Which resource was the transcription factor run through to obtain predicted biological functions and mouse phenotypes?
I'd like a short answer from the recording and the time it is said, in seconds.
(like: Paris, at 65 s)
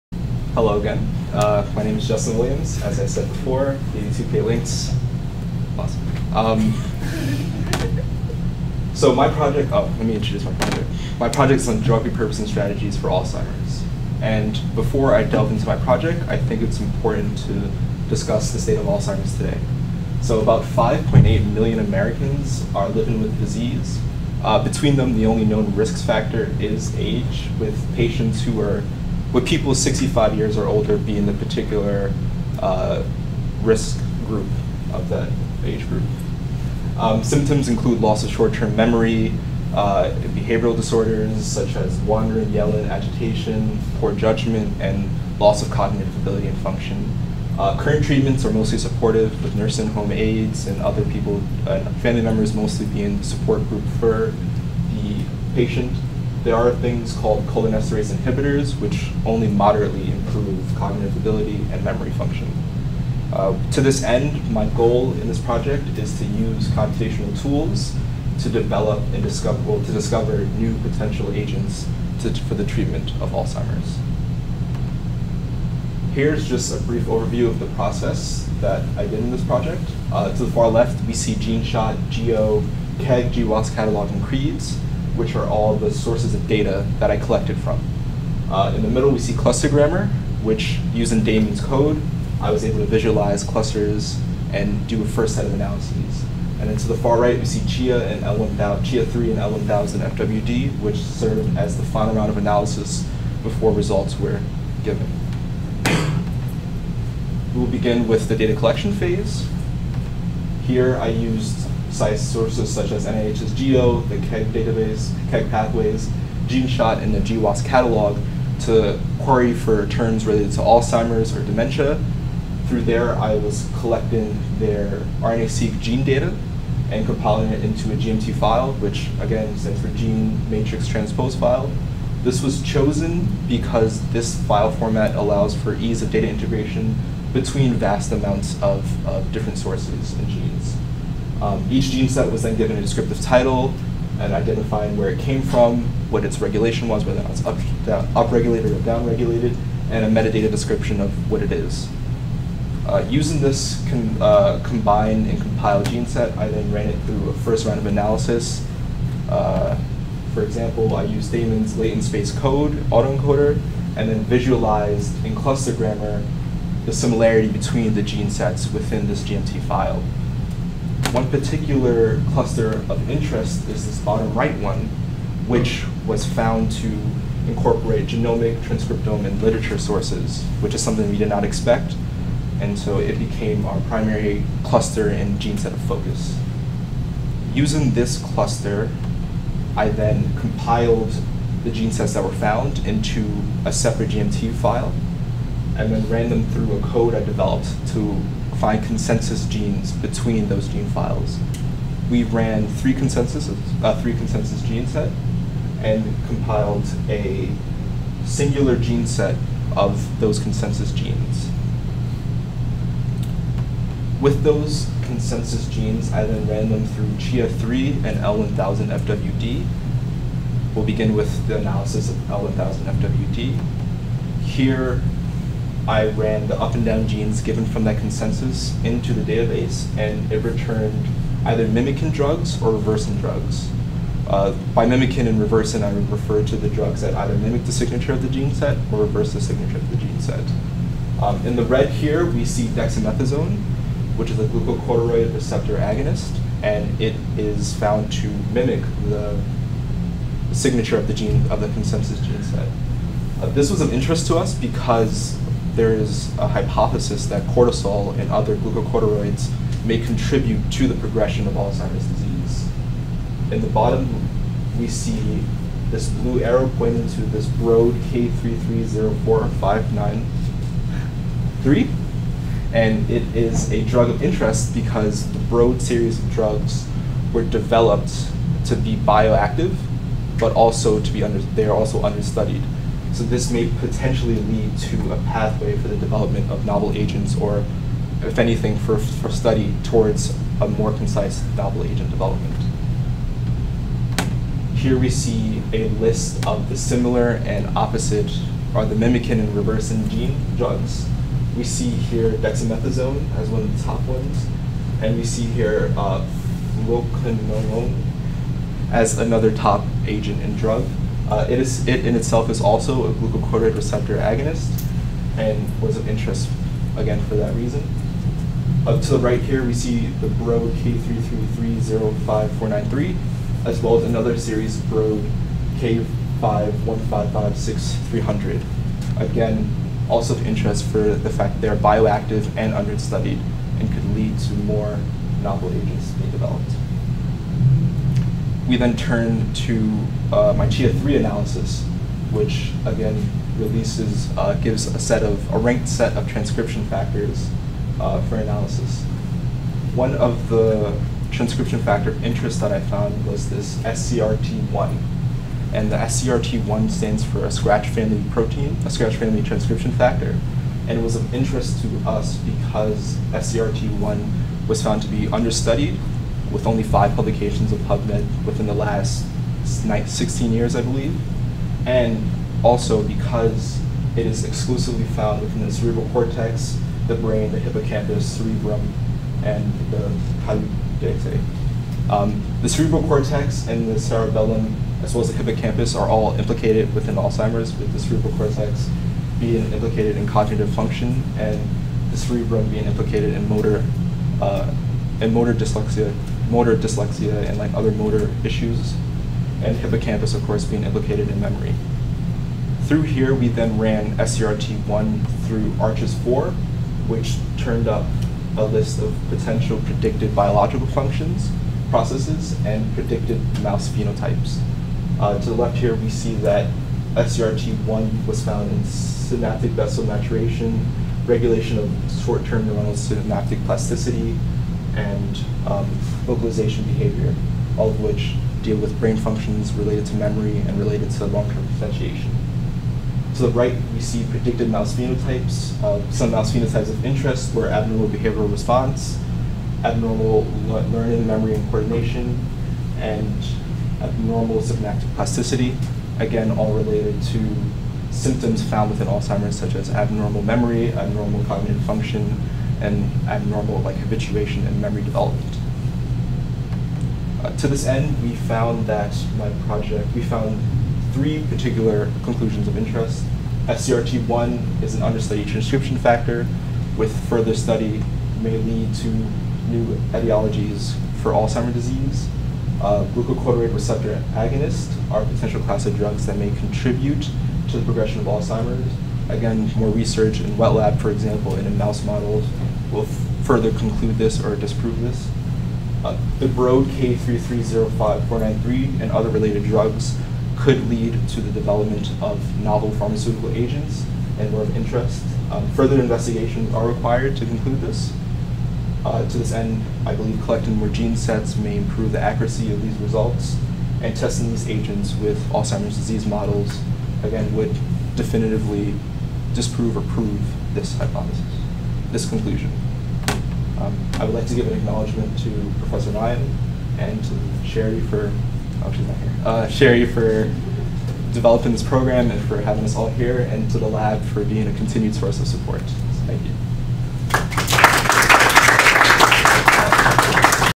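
ARCHS4, at 405 s.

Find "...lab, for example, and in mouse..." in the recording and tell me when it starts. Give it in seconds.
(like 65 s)
480 s.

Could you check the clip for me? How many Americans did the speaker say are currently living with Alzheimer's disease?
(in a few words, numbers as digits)
5.8 million.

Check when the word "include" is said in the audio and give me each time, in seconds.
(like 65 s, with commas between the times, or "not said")
37 s.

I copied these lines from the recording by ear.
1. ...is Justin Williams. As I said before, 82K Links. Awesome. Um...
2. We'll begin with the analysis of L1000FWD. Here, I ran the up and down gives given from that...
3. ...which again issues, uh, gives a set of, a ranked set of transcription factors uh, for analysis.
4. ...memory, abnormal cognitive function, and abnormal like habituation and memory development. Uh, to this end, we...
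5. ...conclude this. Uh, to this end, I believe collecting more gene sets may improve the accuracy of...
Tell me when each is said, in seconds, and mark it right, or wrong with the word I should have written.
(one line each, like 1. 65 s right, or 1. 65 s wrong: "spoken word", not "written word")
1. 1 s right
2. 220 s wrong: "genes", not "gives"
3. 342 s wrong: "releases", not "issues"
4. 450 s right
5. 497 s right.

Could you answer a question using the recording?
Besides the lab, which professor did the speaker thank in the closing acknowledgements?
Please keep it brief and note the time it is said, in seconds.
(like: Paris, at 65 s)
Professor Ma'ayan, at 515 s.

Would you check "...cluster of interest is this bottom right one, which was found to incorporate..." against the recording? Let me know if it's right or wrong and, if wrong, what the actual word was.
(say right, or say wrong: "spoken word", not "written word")
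right.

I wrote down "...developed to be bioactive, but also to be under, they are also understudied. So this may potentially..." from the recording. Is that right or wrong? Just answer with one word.
right.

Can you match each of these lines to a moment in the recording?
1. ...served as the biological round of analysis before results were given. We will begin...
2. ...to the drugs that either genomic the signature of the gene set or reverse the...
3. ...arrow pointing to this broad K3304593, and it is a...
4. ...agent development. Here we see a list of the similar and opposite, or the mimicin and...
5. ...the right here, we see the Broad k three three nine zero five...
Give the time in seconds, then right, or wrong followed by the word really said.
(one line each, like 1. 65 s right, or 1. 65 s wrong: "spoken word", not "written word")
1. 100 s wrong: "final", not "biological"
2. 236 s wrong: "mimic", not "genomic"
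3. 266 s right
4. 291 s right
5. 319 s wrong: "three", not "nine".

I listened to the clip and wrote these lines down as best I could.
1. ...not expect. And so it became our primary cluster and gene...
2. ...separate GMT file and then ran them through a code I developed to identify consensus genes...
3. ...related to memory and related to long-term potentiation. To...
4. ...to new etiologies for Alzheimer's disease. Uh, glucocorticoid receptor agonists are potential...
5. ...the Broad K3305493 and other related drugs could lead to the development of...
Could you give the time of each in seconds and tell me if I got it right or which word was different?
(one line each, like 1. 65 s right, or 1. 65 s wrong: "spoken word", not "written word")
1. 181 s right
2. 193 s right
3. 429 s right
4. 468 s right
5. 486 s right.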